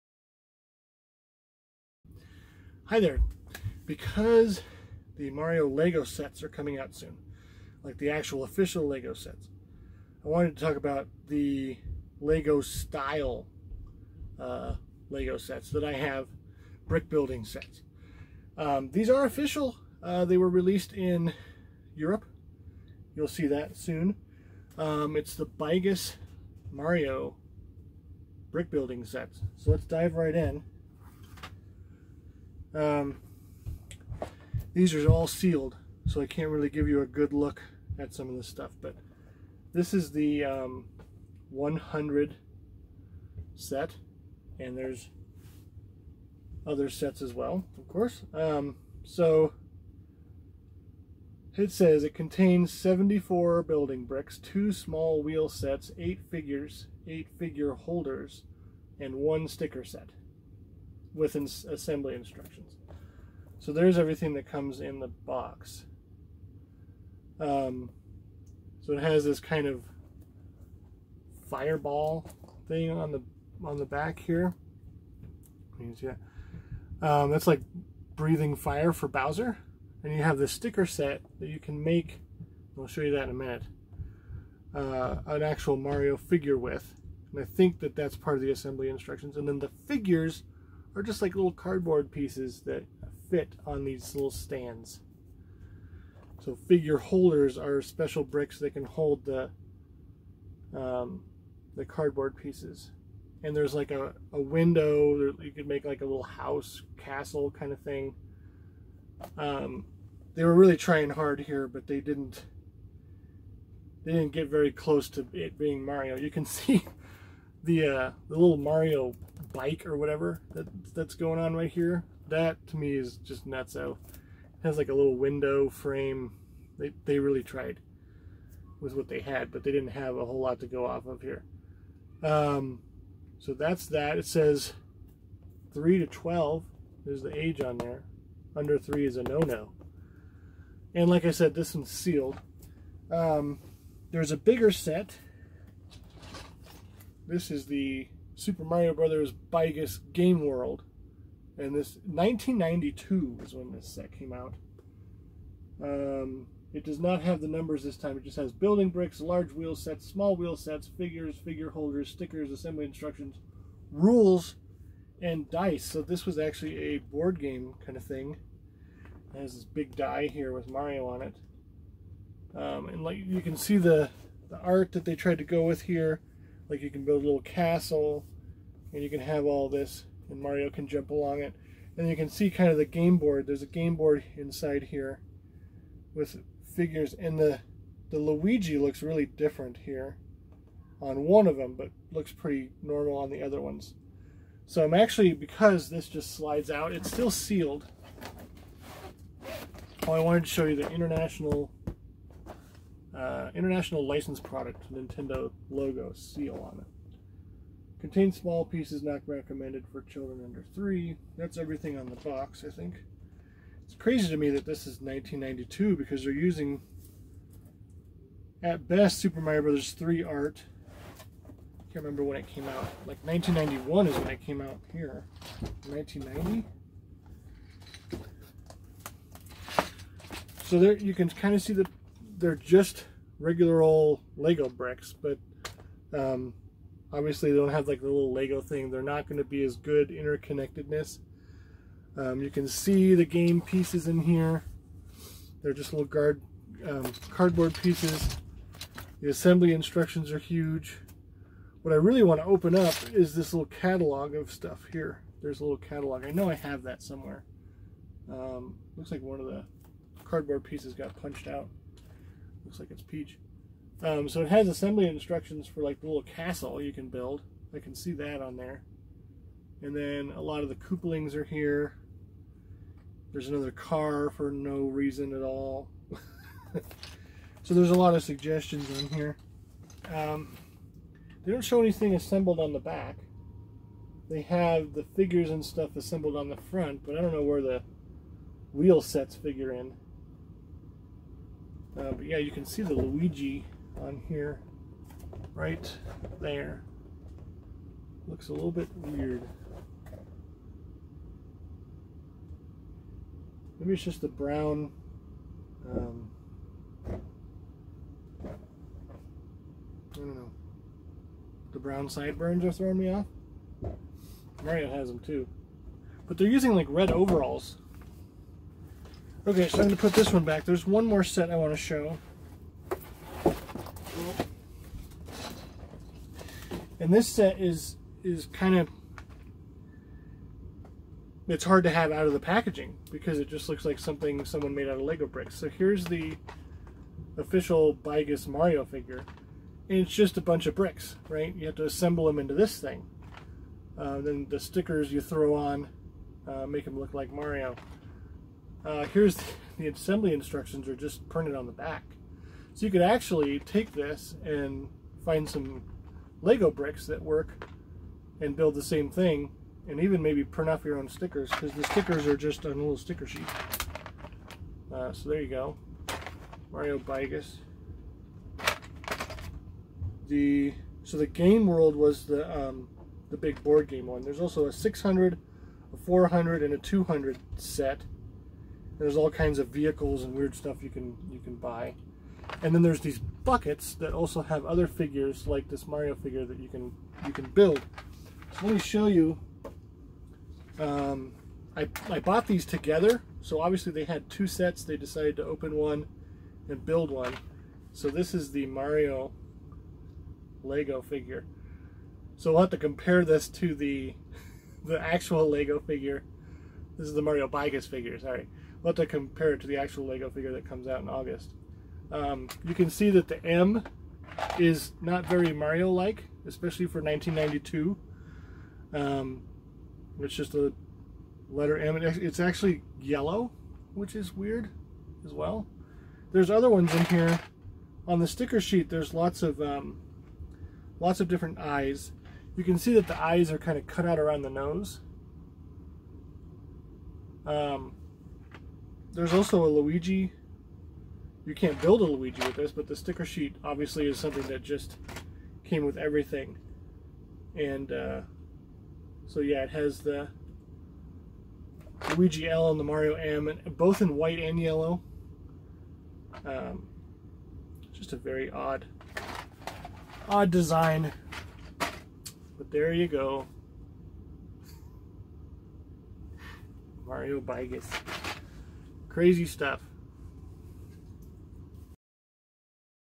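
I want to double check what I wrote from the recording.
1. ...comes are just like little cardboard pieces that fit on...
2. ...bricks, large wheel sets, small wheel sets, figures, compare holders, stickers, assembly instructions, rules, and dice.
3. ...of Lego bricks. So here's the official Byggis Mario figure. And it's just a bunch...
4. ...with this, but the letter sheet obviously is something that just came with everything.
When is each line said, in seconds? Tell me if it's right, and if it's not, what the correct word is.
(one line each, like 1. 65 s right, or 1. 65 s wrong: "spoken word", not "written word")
1. 89 s wrong: "figures", not "comes"
2. 158 s wrong: "figure", not "compare"
3. 334 s right
4. 442 s wrong: "sticker", not "letter".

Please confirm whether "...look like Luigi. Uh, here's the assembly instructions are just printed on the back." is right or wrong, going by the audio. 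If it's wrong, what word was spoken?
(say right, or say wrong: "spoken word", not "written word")
wrong: "Mario", not "Luigi".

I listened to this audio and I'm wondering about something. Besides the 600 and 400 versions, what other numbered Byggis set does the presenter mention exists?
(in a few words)
200.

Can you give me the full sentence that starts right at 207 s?
Contains small pieces not recommended for children under three.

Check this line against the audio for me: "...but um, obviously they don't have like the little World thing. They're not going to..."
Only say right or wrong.
wrong.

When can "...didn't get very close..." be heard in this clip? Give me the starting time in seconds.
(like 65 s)
114 s.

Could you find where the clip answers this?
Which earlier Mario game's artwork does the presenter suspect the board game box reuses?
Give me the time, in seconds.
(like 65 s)
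219 s.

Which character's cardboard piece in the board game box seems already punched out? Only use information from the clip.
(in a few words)
Peach.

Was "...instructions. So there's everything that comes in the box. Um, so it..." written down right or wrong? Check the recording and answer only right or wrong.
right.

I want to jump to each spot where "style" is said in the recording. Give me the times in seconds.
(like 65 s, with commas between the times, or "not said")
12 s.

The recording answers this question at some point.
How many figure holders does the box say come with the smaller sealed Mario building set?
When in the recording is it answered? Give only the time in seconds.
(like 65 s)
57 s.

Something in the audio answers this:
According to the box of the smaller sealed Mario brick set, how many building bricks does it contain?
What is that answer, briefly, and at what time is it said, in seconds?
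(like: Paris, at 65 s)
74, at 52 s.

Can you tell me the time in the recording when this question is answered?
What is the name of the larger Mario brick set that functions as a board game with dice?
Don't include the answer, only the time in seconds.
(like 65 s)
148 s.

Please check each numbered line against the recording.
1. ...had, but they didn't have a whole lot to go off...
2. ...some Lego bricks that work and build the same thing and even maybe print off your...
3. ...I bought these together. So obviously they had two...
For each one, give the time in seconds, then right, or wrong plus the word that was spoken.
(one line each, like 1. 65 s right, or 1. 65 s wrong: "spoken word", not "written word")
1. 129 s right
2. 355 s right
3. 392 s right.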